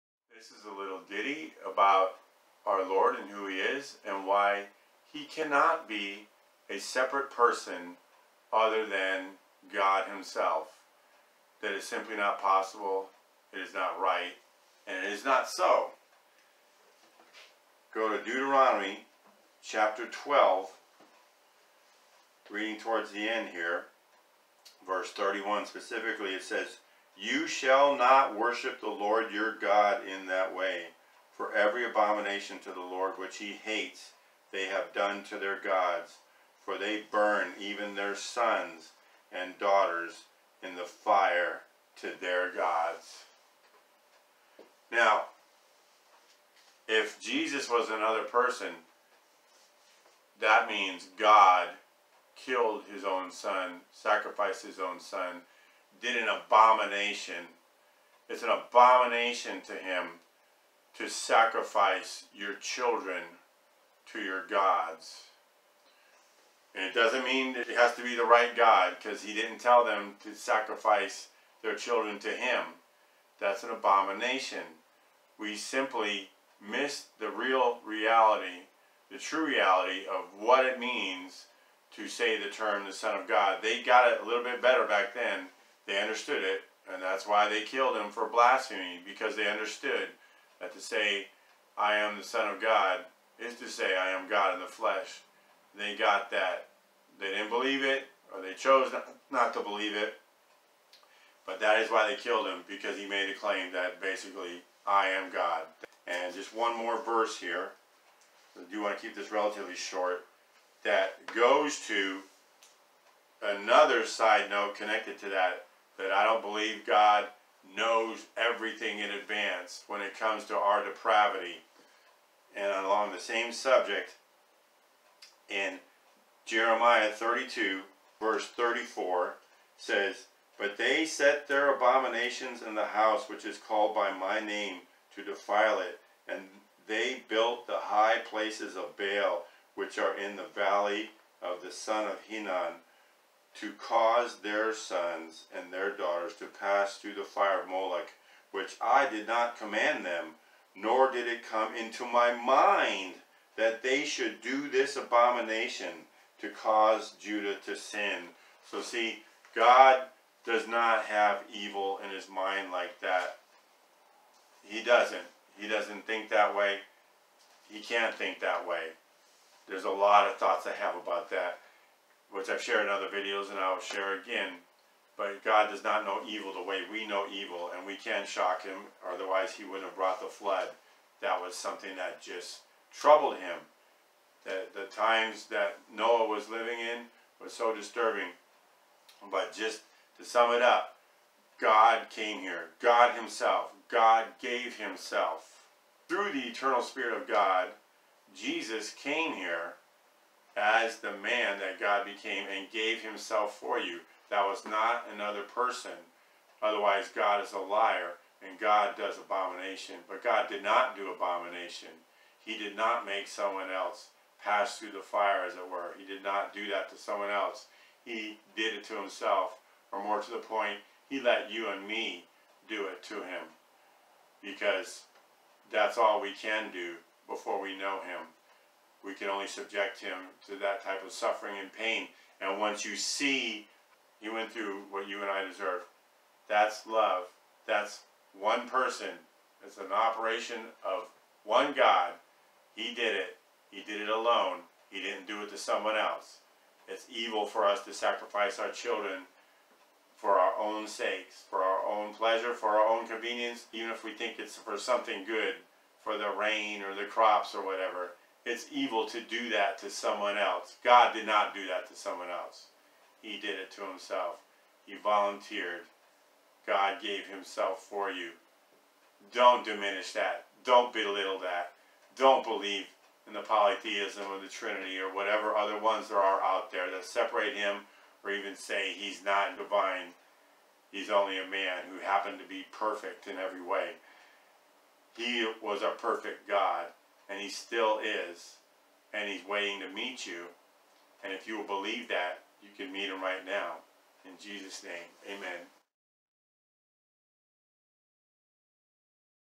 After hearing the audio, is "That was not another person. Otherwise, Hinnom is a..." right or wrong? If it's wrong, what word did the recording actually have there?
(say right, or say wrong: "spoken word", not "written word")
wrong: "God", not "Hinnom".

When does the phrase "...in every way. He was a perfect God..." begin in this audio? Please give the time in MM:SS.
04:43.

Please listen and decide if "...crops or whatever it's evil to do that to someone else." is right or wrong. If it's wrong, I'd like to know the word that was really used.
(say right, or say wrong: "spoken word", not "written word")
right.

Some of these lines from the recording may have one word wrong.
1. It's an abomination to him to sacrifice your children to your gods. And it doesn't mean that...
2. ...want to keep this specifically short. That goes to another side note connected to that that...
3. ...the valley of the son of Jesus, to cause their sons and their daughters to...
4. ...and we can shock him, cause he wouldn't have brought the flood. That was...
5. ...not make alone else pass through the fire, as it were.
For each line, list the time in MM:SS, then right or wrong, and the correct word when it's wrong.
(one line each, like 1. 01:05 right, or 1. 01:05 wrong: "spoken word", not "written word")
1. 00:58 right
2. 01:48 wrong: "relatively", not "specifically"
3. 02:20 wrong: "Hinnom", not "Jesus"
4. 02:57 wrong: "otherwise", not "cause"
5. 03:32 wrong: "someone", not "alone".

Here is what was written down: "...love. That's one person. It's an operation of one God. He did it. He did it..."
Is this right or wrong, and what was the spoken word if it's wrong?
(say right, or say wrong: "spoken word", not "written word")
right.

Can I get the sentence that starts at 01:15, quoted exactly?
We simply miss the real reality, the true reality of what it means to say the term the Son of God.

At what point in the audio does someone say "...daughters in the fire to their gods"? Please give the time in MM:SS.
00:39.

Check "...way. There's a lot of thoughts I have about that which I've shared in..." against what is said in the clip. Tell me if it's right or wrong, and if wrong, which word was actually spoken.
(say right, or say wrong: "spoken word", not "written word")
right.